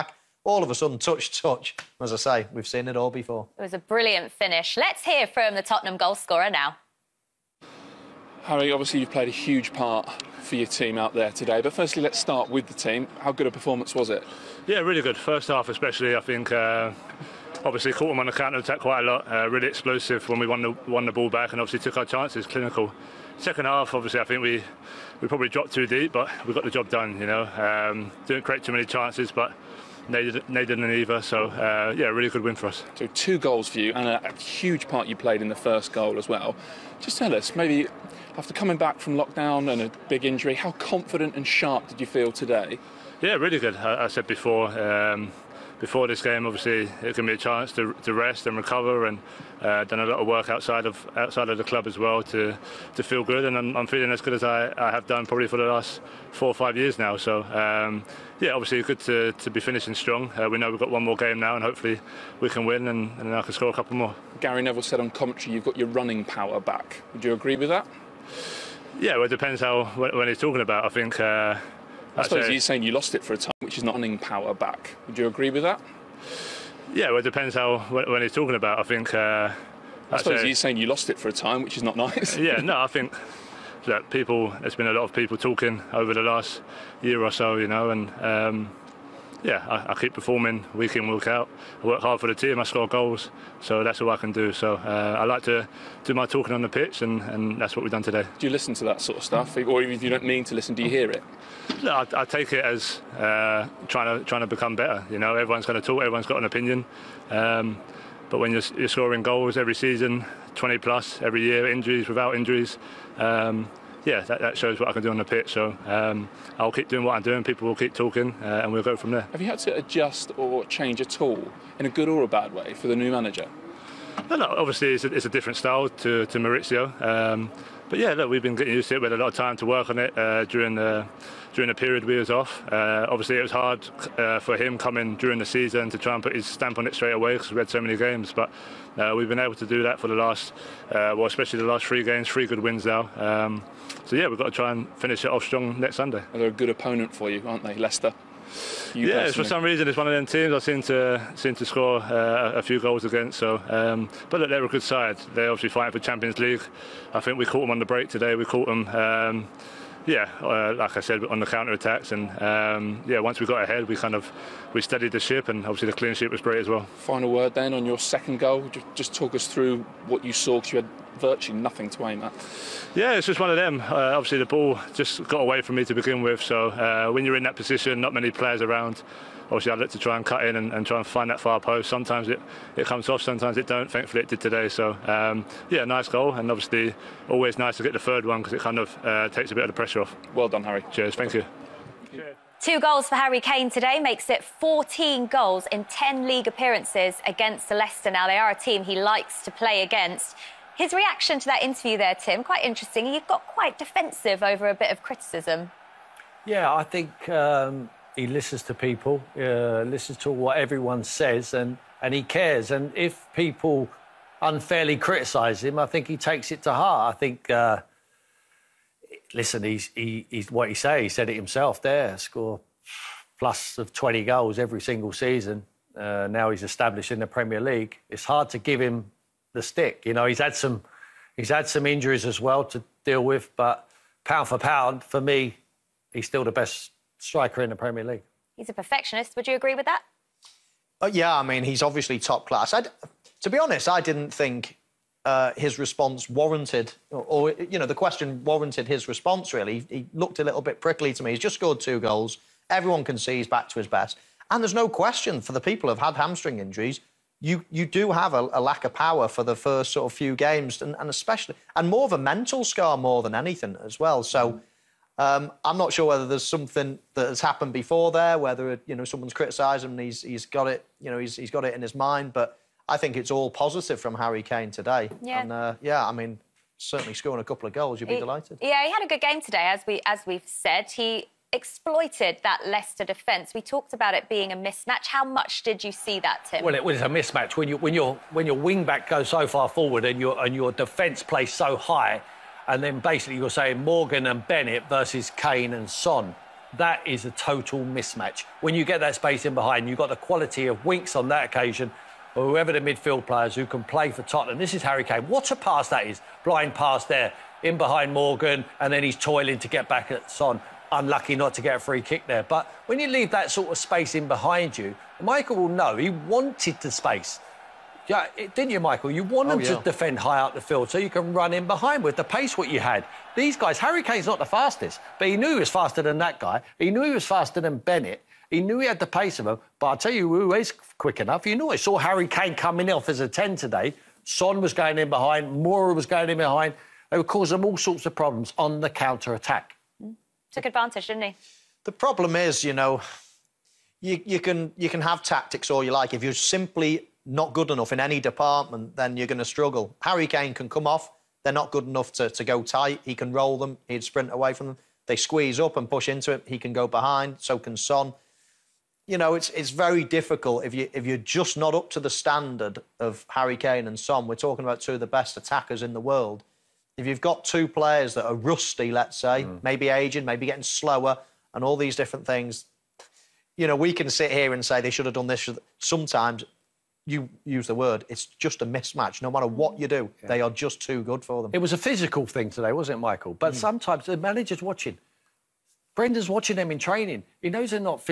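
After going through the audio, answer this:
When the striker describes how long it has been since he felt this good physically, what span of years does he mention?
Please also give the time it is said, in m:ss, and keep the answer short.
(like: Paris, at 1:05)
4 or 5 years, at 0:56.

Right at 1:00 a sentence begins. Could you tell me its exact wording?
Uh, we know we've got one more game now, and hopefully, we can win, and, and I can score a couple more.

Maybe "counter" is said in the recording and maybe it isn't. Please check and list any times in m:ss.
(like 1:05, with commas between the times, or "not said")
0:18, 2:41, 5:38.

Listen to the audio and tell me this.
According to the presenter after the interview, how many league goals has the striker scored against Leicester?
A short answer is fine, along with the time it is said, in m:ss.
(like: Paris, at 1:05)
14, at 3:14.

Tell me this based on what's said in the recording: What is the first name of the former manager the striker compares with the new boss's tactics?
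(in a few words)
Mauricio.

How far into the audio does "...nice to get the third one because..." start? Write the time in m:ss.
3:07.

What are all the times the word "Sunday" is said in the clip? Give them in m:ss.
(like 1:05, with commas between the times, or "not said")
2:25.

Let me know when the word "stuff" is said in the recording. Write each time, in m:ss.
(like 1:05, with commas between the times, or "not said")
1:39.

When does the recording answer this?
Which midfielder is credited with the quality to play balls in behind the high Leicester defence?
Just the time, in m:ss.
5:00.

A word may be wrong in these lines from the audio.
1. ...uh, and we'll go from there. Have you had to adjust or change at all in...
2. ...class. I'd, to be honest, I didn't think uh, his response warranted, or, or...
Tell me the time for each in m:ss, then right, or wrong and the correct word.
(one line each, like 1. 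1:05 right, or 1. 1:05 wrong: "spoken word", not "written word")
1. 1:58 right
2. 4:02 right.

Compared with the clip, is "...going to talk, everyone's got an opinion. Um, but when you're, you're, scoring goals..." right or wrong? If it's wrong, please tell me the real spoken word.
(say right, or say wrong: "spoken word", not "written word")
right.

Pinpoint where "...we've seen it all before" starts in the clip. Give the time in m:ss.
0:02.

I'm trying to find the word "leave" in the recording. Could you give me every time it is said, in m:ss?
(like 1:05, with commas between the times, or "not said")
5:13.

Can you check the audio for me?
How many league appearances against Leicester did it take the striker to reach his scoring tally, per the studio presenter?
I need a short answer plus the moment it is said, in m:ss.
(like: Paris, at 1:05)
10, at 3:15.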